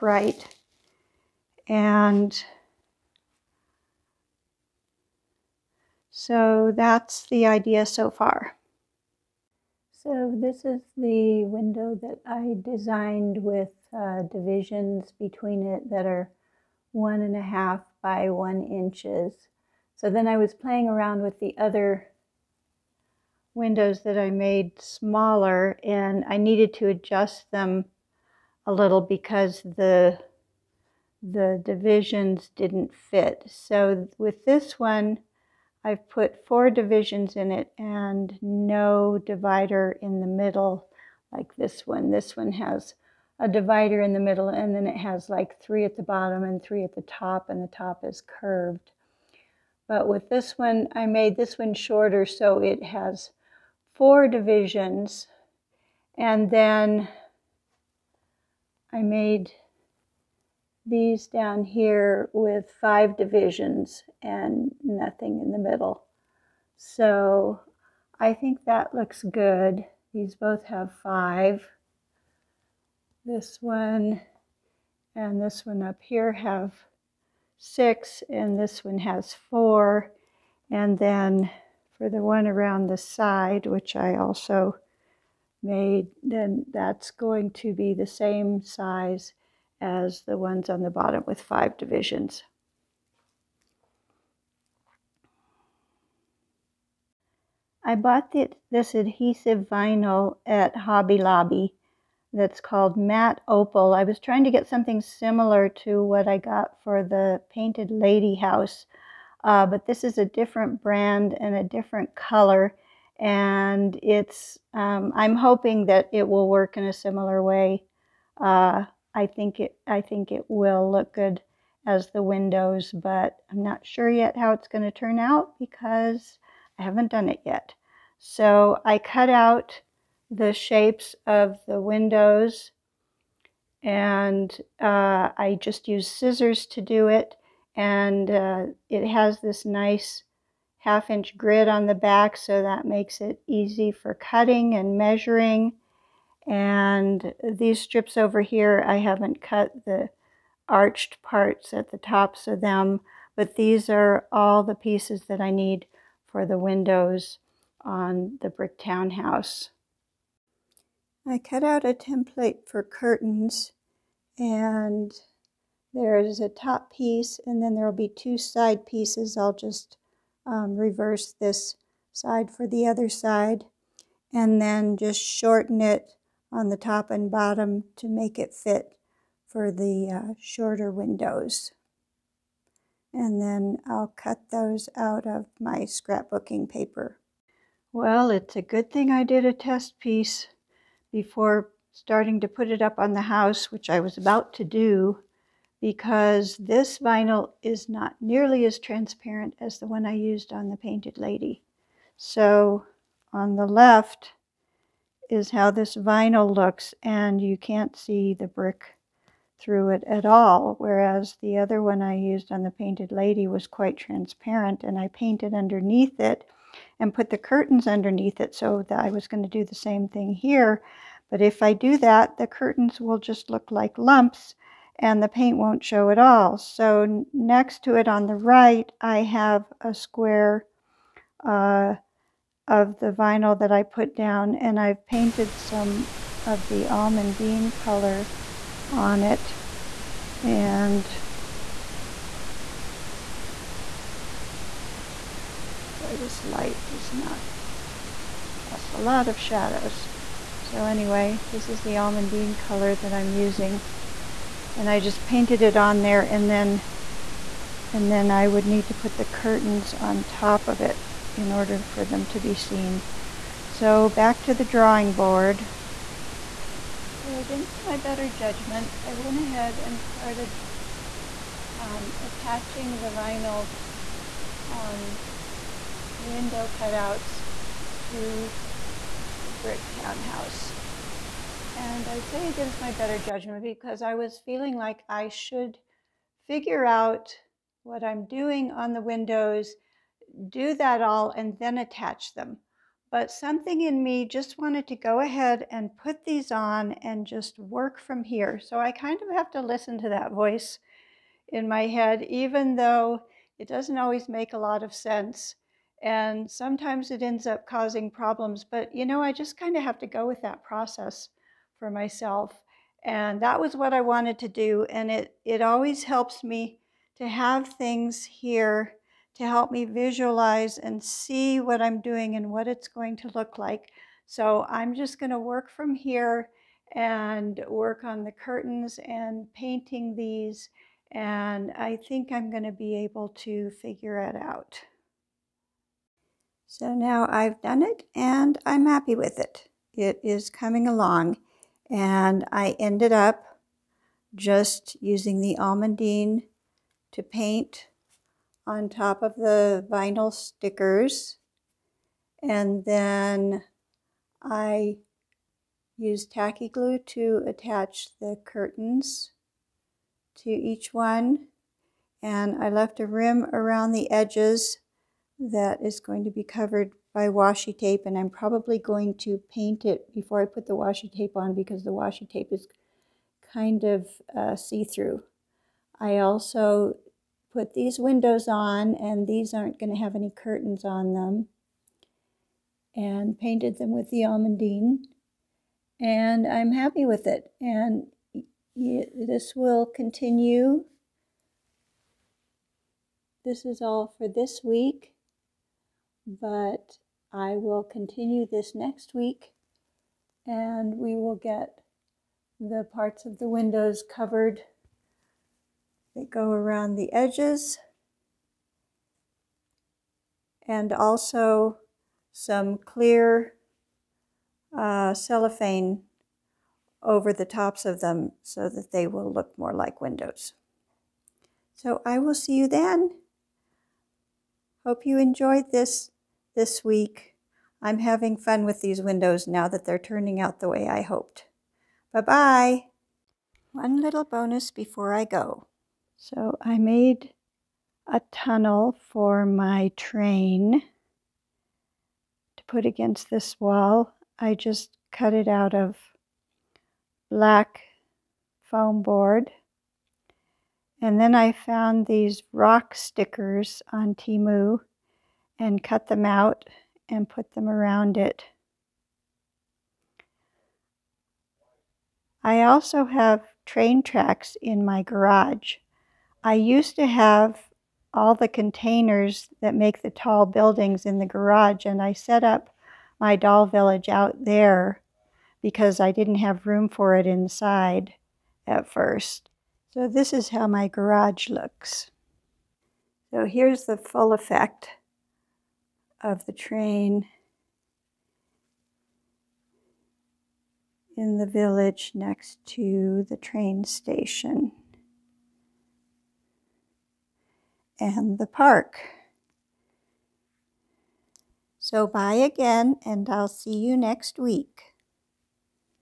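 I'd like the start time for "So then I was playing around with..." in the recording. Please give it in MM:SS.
00:19.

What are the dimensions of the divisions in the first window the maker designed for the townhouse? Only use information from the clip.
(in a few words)
1.5 by 1 inches.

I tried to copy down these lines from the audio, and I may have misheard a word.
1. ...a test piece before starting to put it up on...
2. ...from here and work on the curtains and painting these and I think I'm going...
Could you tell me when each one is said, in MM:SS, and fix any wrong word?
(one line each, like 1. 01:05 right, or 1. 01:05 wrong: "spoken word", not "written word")
1. 03:09 right
2. 05:25 right.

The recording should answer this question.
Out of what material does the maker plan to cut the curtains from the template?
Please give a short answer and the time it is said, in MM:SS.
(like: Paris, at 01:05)
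Scrapbooking paper, at 03:05.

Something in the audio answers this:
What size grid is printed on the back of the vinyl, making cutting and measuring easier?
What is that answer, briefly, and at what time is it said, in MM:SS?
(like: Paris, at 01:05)
Half inch, at 02:20.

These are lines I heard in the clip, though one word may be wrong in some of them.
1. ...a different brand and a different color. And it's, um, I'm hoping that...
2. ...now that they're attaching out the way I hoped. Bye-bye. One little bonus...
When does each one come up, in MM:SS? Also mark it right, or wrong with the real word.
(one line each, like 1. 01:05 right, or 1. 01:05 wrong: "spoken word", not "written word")
1. 01:50 right
2. 07:09 wrong: "turning", not "attaching".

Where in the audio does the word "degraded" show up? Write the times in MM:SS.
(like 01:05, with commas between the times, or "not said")
not said.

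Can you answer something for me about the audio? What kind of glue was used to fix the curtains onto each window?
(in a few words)
Tacky glue.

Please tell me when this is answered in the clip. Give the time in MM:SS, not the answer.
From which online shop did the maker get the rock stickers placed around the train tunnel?
07:34.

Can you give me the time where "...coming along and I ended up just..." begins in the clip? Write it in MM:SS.
05:40.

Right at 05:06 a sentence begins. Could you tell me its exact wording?
And sometimes it ends up causing problems.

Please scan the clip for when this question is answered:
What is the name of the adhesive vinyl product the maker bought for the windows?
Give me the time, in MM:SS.
01:42.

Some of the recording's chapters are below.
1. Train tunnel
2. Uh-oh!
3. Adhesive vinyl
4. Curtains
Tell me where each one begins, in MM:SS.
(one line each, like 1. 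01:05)
1. 07:13
2. 03:07
3. 01:36
4. 02:40.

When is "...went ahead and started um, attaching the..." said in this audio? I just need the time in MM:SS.
04:29.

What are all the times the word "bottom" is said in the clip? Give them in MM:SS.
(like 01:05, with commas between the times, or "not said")
00:46, 01:30, 02:57.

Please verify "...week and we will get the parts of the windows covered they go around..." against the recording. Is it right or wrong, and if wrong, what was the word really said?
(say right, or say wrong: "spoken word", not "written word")
right.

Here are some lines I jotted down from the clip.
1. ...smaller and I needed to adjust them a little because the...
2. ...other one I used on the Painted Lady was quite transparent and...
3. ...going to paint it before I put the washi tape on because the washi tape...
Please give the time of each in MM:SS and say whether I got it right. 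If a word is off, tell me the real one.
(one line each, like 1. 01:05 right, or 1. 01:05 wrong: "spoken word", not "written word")
1. 00:24 right
2. 03:31 right
3. 06:08 right.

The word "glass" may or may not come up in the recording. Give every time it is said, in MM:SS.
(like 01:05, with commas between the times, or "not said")
not said.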